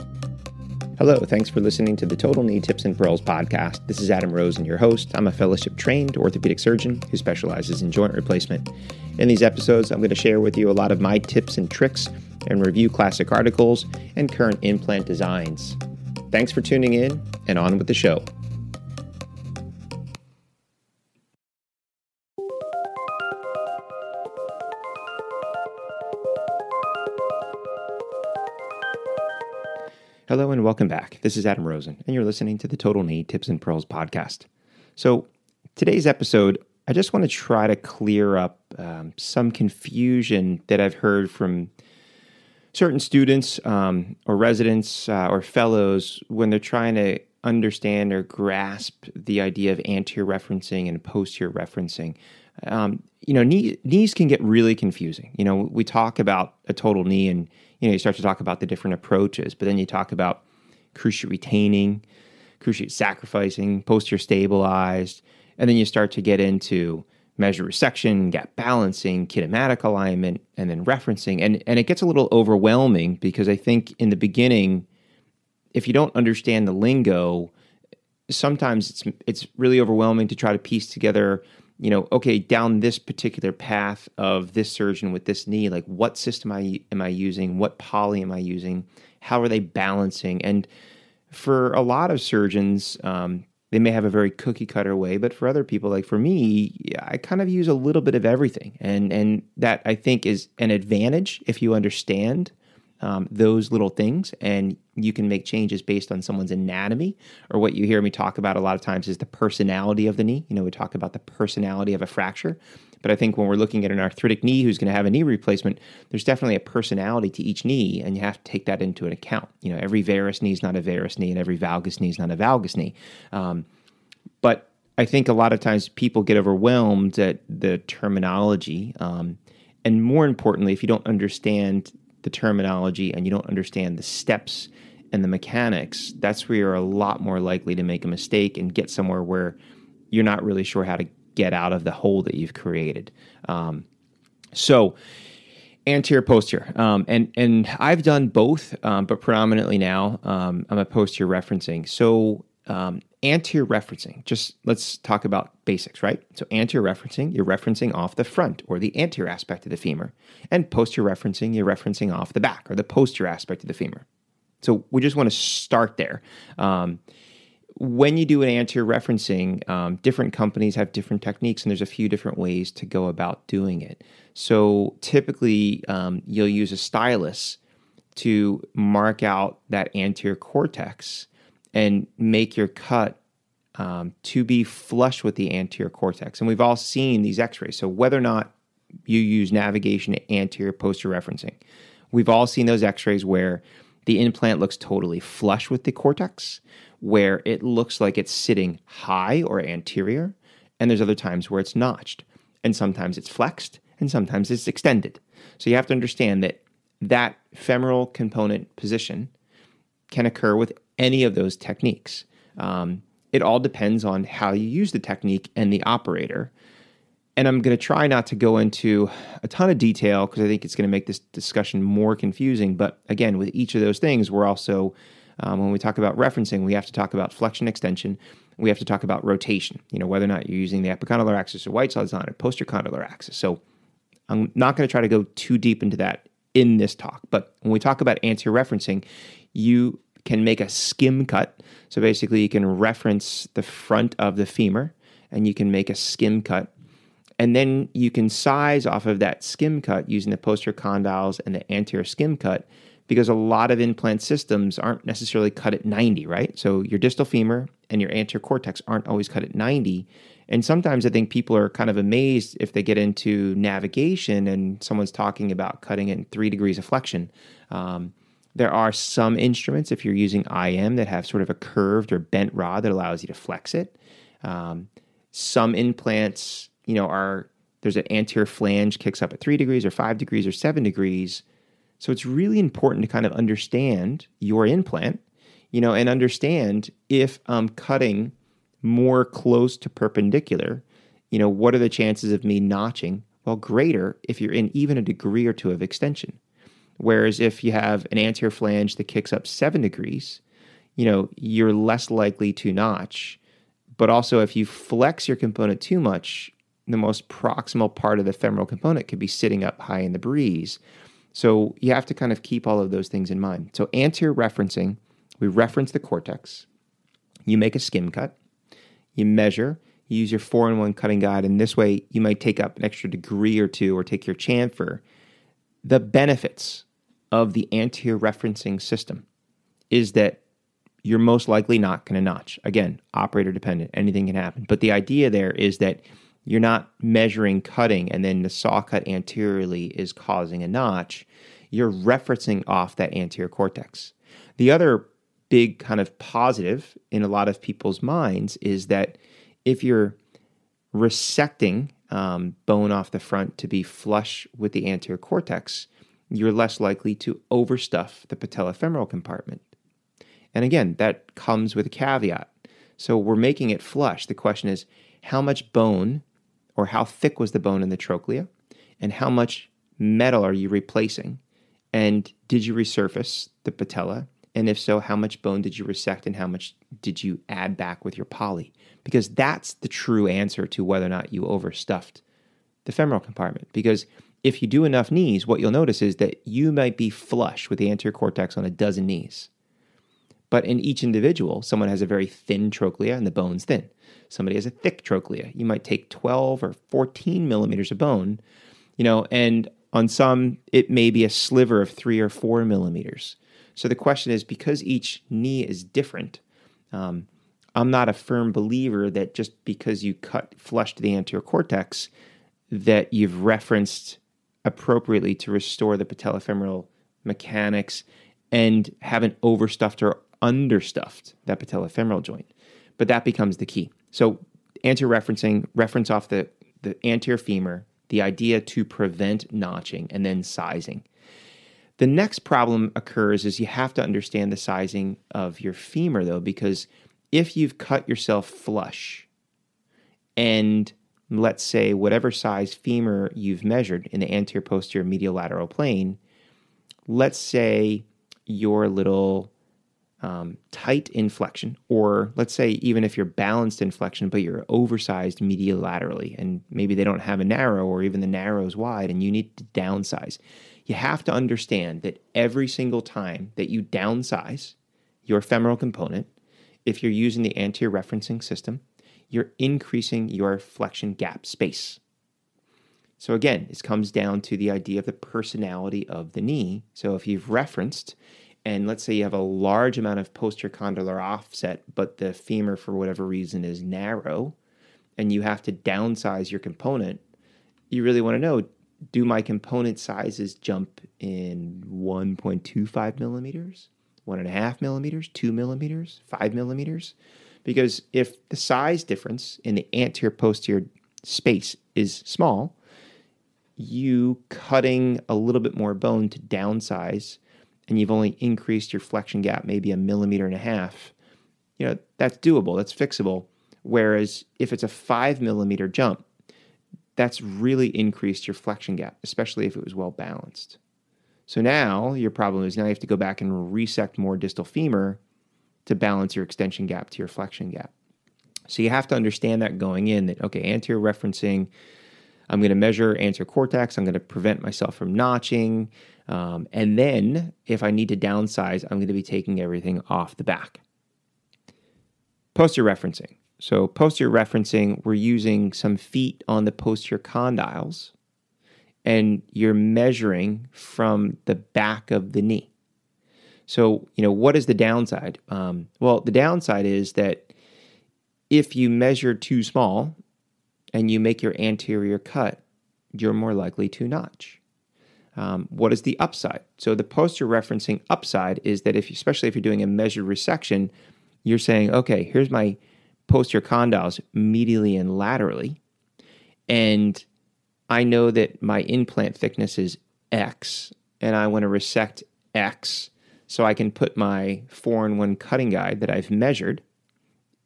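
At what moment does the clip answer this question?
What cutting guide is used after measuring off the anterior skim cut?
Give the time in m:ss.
5:20.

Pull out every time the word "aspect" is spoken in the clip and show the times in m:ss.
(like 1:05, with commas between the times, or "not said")
2:39, 2:43.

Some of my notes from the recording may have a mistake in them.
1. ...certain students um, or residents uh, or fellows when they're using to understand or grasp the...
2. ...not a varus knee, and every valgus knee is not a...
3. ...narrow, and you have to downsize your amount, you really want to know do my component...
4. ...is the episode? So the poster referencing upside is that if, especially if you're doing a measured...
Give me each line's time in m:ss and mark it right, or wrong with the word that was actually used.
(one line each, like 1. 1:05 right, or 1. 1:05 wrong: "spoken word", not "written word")
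1. 0:42 wrong: "trying", not "using"
2. 2:00 right
3. 8:03 wrong: "component", not "amount"
4. 9:25 wrong: "upside", not "episode".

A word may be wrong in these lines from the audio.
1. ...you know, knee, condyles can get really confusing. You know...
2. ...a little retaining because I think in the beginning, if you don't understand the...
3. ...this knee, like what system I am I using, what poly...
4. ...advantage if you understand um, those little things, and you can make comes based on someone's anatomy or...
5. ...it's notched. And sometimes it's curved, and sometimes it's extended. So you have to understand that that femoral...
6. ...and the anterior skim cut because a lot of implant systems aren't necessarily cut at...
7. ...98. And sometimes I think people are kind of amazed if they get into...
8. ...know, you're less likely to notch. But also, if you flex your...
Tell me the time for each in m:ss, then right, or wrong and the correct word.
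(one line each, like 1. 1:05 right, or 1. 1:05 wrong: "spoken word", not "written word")
1. 0:53 wrong: "knees", not "condyles"
2. 1:12 wrong: "overwhelming", not "retaining"
3. 1:25 right
4. 1:40 wrong: "changes", not "comes"
5. 3:21 wrong: "flexed", not "curved"
6. 4:11 right
7. 4:19 wrong: "90", not "98"
8. 5:01 right.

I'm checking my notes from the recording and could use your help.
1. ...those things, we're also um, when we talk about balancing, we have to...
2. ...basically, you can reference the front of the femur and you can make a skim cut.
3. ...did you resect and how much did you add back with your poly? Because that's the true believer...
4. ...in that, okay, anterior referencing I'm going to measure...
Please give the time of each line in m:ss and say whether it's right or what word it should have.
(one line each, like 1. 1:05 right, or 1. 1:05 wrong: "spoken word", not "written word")
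1. 3:43 wrong: "referencing", not "balancing"
2. 4:02 right
3. 6:15 wrong: "answer", not "believer"
4. 8:50 right.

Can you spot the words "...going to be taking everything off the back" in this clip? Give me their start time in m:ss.
8:58.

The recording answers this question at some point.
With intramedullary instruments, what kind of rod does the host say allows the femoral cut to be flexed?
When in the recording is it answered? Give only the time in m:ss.
4:31.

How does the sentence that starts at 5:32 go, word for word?
Again, operator dependent, anything can happen.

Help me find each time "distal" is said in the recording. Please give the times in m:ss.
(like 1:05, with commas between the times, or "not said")
4:16, 8:44.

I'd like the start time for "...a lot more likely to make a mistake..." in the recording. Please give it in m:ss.
2:16.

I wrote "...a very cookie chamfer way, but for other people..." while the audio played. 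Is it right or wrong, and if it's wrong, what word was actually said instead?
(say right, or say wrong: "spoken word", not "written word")
wrong: "cutter", not "chamfer".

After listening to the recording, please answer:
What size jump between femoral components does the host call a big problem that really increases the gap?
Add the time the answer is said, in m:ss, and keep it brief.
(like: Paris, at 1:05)
5 millimeters, at 8:34.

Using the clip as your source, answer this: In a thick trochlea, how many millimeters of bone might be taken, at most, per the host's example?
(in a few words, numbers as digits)
14.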